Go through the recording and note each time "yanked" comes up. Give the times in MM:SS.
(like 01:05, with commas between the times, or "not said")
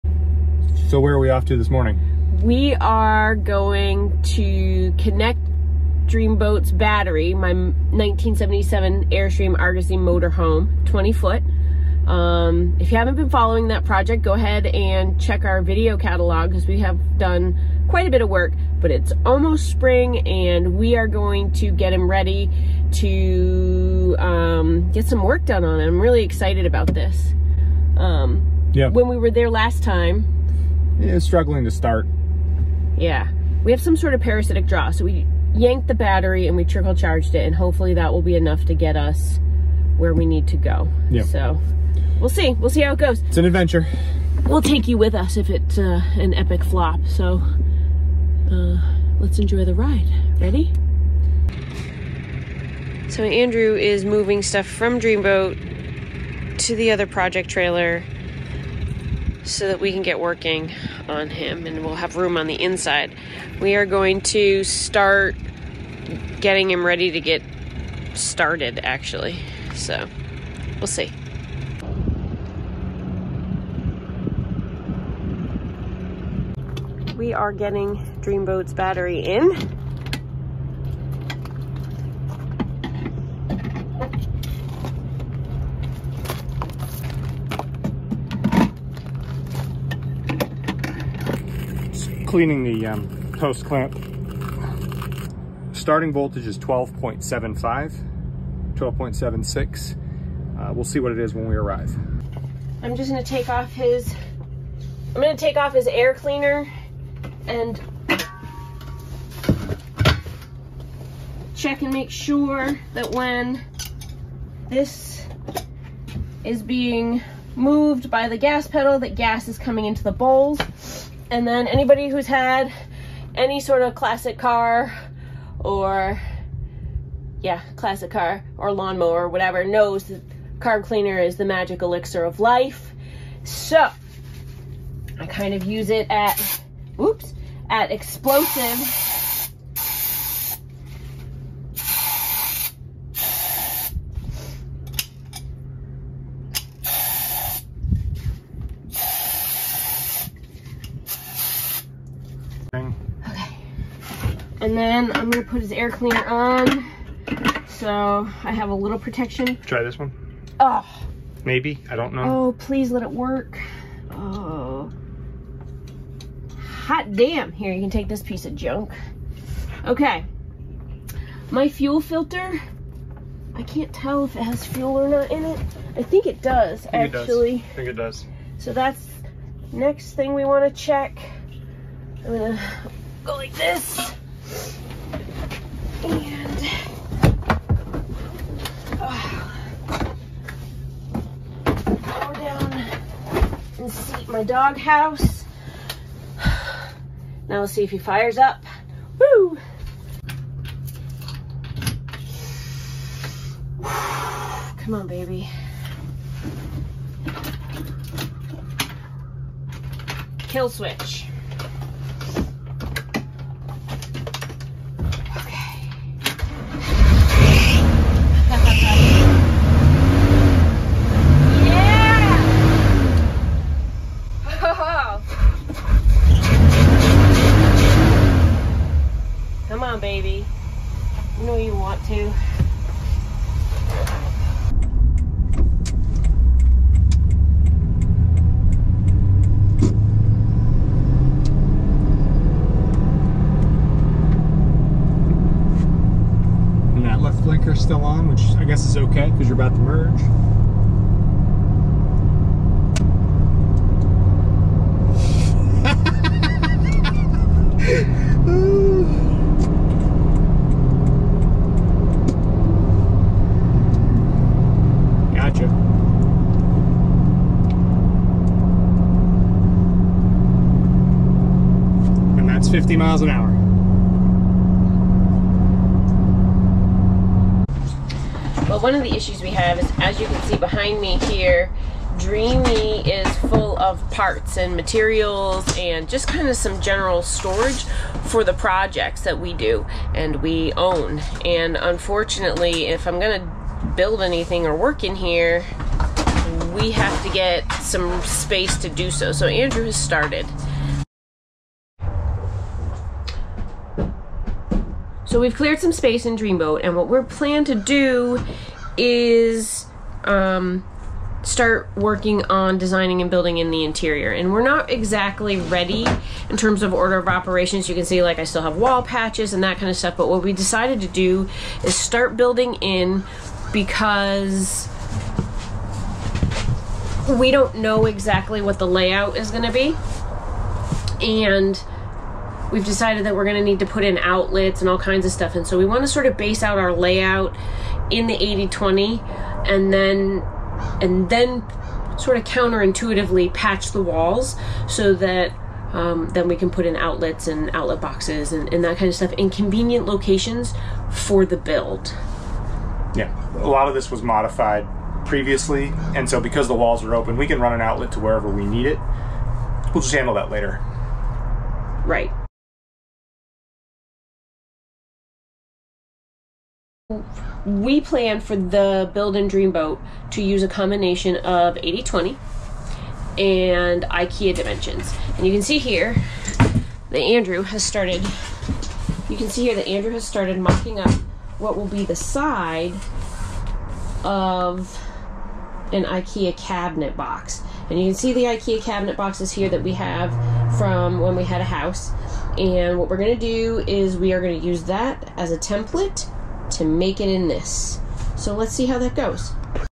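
00:35.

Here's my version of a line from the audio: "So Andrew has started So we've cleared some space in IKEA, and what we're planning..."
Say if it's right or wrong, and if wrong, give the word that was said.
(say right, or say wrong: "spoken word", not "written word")
wrong: "Dreamboat", not "IKEA".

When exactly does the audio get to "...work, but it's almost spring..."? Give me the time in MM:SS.
00:18.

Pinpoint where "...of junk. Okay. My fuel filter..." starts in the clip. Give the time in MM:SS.
02:48.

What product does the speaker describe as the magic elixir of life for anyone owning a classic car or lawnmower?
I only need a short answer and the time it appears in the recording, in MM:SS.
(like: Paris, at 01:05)
carb cleaner, at 02:10.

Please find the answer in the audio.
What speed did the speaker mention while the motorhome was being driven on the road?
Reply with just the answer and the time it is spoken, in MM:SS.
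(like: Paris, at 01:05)
50 miles an hour, at 04:32.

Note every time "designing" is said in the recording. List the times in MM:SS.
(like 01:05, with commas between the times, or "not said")
05:12.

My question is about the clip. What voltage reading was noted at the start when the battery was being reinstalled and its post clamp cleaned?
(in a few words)
12.75.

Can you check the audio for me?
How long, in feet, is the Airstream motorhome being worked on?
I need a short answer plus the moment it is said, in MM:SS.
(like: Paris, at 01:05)
20 feet, at 00:10.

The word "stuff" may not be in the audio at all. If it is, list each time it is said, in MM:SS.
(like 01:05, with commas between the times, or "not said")
00:54, 05:19, 05:35, 05:49.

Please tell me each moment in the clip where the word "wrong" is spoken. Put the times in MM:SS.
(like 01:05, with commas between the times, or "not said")
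not said.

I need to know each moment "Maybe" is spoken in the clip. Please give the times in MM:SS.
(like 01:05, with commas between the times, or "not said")
02:41.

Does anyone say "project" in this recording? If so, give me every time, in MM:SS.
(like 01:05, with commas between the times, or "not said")
00:13, 00:57, 04:48.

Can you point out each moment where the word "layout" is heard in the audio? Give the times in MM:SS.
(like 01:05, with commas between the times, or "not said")
05:28, 05:36.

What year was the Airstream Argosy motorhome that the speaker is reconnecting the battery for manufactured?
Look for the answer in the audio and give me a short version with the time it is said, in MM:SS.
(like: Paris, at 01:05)
1977, at 00:07.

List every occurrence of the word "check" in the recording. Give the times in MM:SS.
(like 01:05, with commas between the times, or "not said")
00:15, 01:51, 03:00.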